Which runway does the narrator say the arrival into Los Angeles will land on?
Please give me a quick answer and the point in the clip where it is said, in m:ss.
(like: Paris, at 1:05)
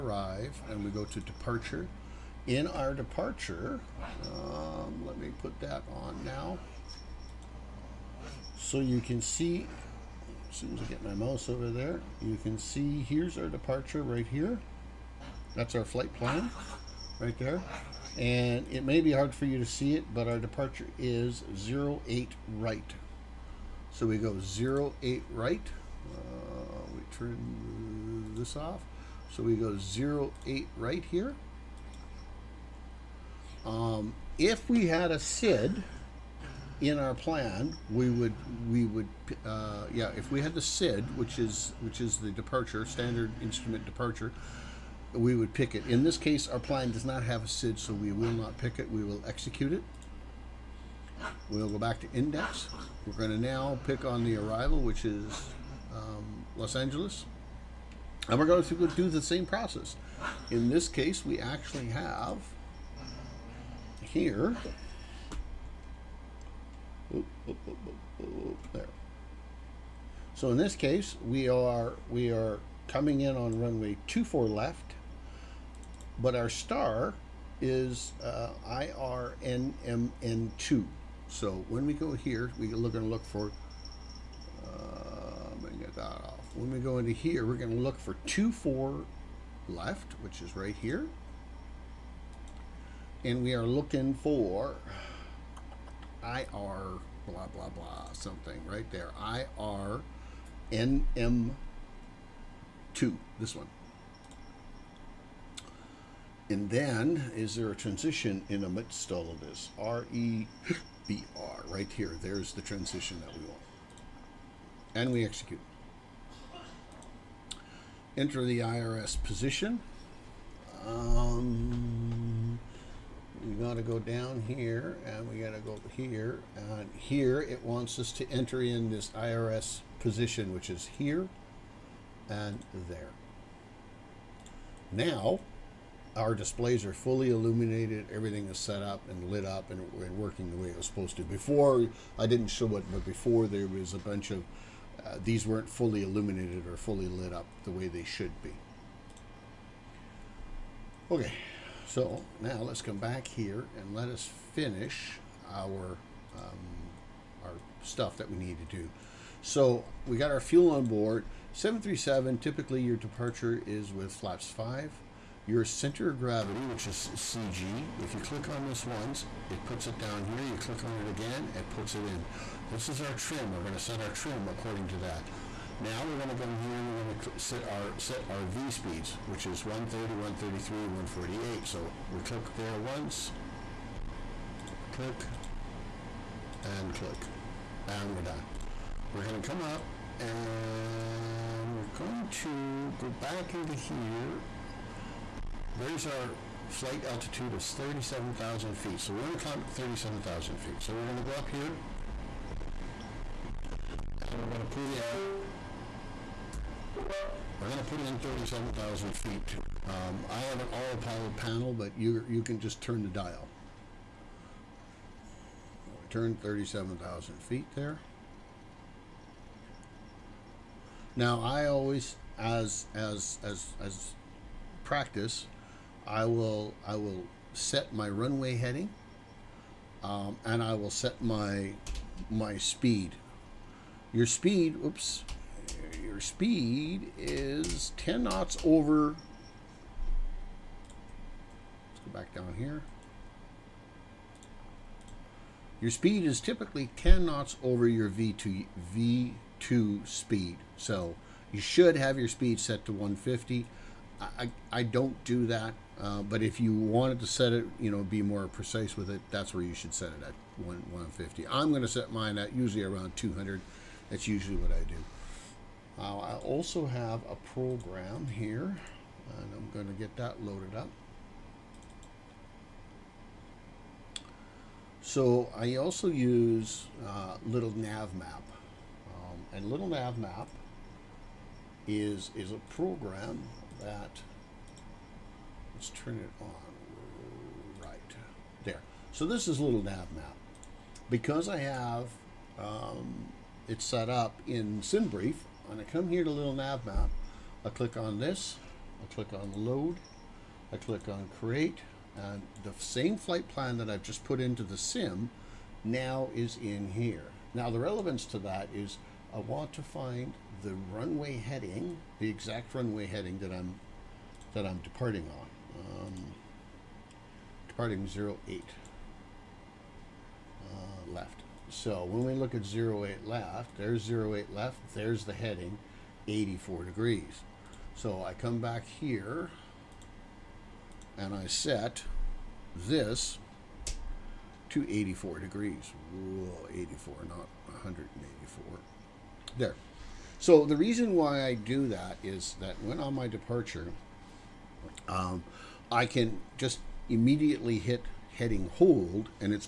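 24 left, at 1:13.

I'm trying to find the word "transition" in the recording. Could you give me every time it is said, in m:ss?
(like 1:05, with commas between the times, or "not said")
1:47, 1:52.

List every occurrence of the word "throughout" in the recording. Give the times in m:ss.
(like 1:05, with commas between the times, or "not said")
not said.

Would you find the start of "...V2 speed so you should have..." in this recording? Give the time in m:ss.
4:08.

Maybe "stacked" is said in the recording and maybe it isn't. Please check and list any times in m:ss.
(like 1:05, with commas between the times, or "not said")
not said.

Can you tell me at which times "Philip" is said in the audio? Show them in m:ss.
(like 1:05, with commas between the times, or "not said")
not said.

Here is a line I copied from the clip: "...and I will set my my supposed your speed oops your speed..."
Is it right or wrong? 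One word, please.
wrong.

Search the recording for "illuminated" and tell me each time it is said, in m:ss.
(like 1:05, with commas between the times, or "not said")
2:17, 2:26.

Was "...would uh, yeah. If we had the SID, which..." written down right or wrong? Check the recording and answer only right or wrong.
right.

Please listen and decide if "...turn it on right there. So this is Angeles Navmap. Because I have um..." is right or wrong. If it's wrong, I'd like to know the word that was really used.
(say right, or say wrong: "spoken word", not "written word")
wrong: "Little", not "Angeles".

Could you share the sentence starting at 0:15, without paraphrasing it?
That's our flight plan right there.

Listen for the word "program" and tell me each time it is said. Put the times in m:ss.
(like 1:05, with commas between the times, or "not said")
4:27, 4:42.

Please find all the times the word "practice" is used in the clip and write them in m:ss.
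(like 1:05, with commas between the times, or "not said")
3:44.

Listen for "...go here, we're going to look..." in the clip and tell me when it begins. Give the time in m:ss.
1:21.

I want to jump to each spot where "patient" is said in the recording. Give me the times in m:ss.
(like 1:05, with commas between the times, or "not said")
not said.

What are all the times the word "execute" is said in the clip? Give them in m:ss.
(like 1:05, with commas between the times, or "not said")
0:49, 1:55.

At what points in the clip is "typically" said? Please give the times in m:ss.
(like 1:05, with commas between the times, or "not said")
2:42, 4:06.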